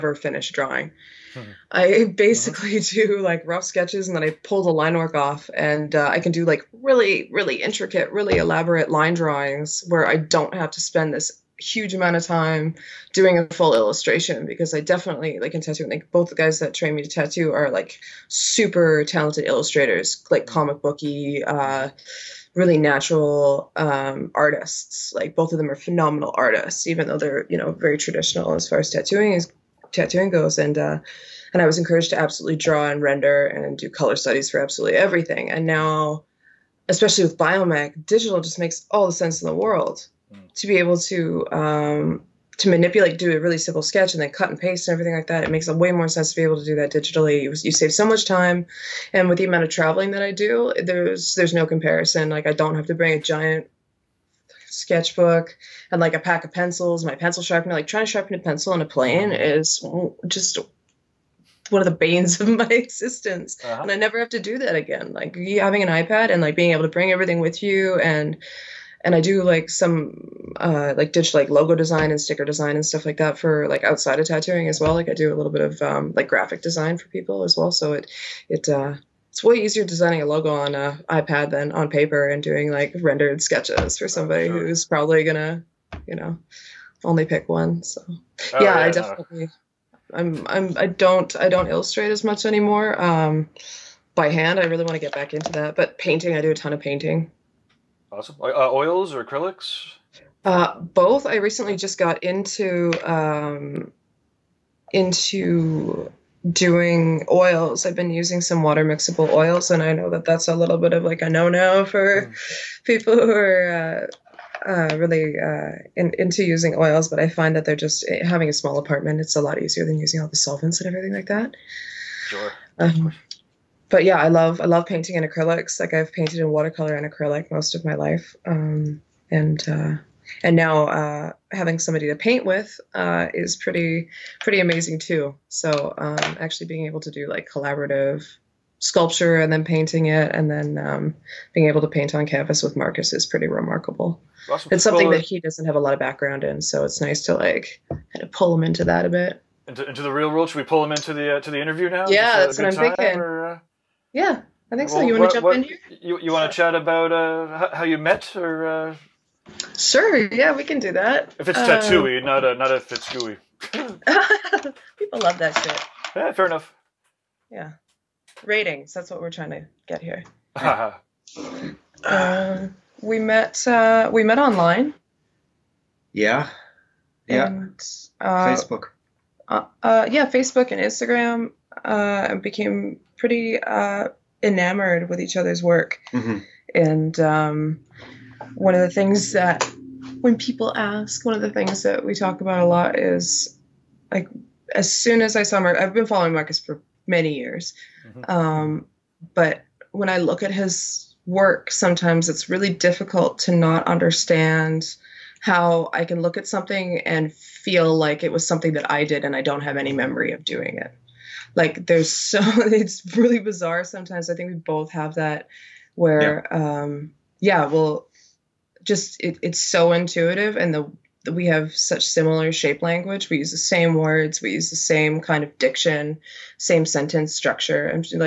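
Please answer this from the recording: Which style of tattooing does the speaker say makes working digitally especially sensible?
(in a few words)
biomech.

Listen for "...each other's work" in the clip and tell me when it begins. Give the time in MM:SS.
03:05.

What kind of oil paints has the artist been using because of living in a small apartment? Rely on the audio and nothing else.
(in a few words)
water mixable oils.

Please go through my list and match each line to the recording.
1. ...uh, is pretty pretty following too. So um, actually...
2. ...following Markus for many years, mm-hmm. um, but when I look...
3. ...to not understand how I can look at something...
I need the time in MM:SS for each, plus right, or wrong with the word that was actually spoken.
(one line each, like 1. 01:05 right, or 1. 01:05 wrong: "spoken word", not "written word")
1. 02:12 wrong: "amazing", not "following"
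2. 03:16 right
3. 03:23 right.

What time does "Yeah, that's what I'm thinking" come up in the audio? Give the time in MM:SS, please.
02:32.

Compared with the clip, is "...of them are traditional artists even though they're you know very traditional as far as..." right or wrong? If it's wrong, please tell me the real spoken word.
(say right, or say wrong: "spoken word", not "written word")
wrong: "phenomenal", not "traditional".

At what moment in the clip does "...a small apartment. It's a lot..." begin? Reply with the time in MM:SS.
01:58.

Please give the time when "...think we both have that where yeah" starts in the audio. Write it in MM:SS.
03:34.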